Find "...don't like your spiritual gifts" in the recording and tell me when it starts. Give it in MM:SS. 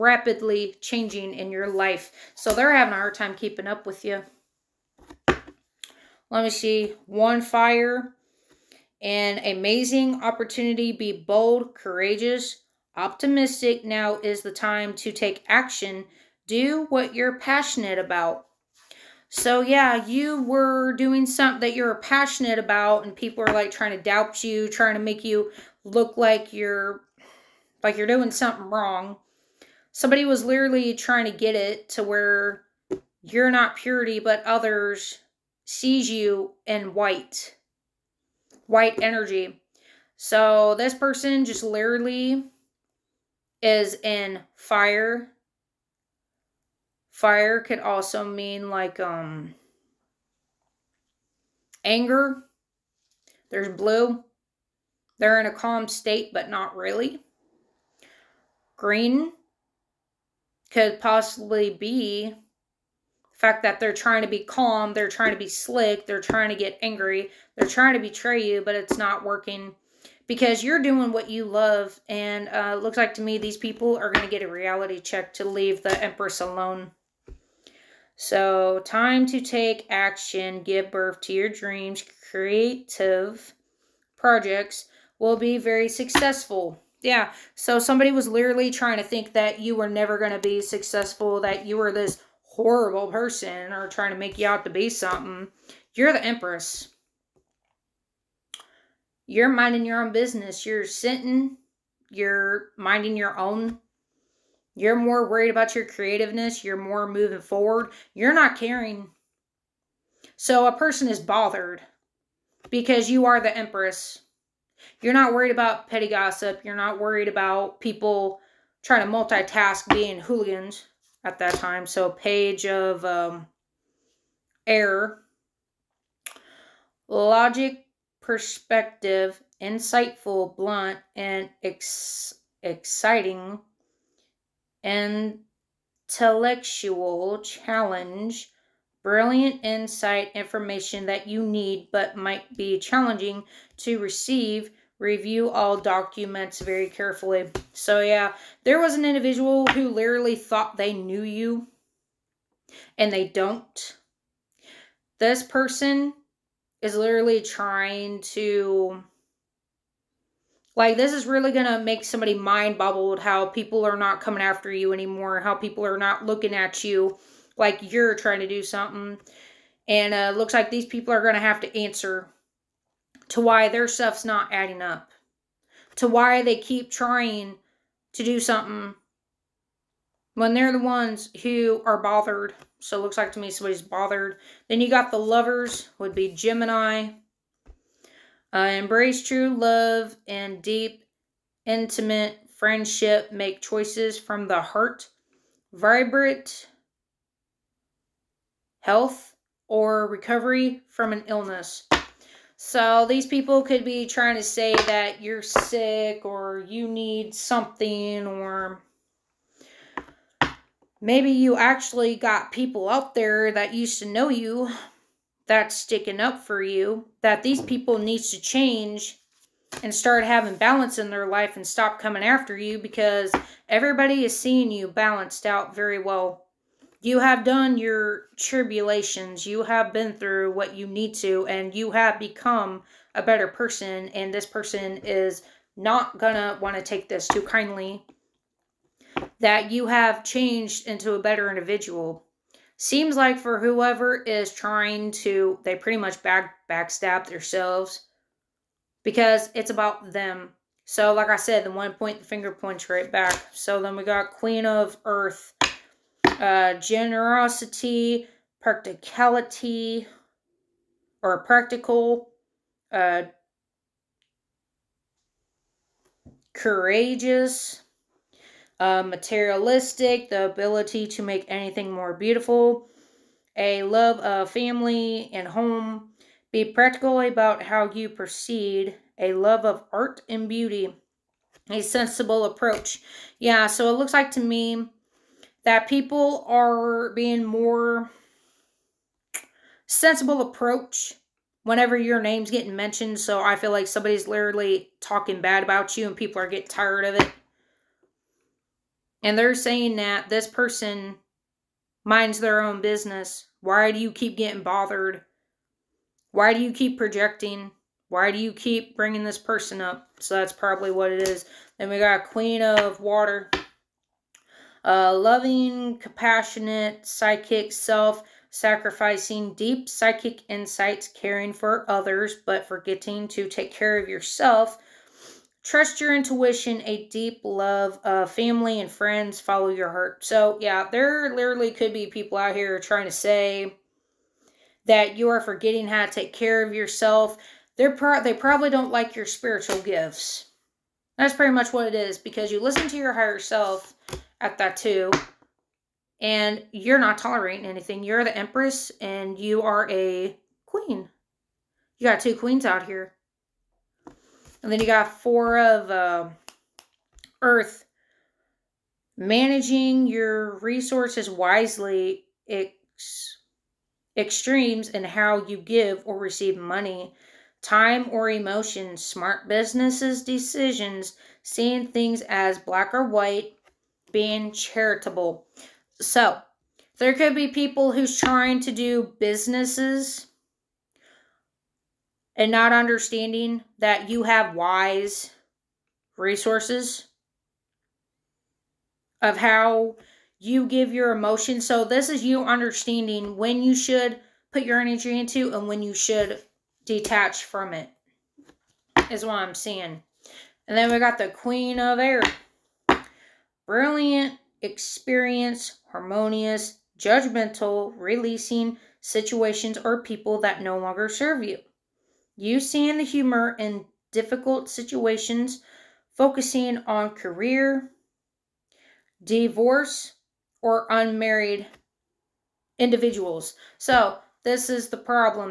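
05:38.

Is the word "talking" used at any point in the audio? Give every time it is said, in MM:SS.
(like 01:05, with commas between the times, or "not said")
04:55.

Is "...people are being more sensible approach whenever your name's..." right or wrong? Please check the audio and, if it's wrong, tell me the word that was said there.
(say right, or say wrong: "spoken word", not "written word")
right.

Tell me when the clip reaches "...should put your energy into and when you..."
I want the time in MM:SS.
06:33.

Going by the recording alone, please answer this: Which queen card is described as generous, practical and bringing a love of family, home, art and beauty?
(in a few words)
Queen of Earth.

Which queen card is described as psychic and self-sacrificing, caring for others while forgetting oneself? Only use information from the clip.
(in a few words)
Queen of Water.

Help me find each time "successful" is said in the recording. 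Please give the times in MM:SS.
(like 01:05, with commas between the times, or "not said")
01:25, 01:30.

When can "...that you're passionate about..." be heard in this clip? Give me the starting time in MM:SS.
00:21.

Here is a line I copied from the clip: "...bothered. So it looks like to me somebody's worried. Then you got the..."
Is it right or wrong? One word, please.
wrong.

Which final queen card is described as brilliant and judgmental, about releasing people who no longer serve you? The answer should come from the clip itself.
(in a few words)
Queen of Air.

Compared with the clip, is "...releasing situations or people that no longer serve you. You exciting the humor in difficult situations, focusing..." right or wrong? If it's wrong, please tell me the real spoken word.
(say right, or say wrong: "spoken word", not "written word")
wrong: "seeing", not "exciting".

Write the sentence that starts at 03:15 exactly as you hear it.
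Vibrant health or recovery from an illness.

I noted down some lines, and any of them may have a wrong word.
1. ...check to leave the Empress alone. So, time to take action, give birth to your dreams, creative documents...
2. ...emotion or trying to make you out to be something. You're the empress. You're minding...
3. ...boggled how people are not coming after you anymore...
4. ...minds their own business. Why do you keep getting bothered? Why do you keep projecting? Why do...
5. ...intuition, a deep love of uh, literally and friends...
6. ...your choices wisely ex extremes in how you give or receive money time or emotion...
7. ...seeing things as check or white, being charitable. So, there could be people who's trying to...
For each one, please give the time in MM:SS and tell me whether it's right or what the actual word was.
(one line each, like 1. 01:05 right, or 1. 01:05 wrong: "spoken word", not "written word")
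1. 01:14 wrong: "projects", not "documents"
2. 01:33 wrong: "person", not "emotion"
3. 02:42 right
4. 05:02 right
5. 05:26 wrong: "family", not "literally"
6. 06:00 wrong: "resources", not "choices"
7. 06:11 wrong: "black", not "check".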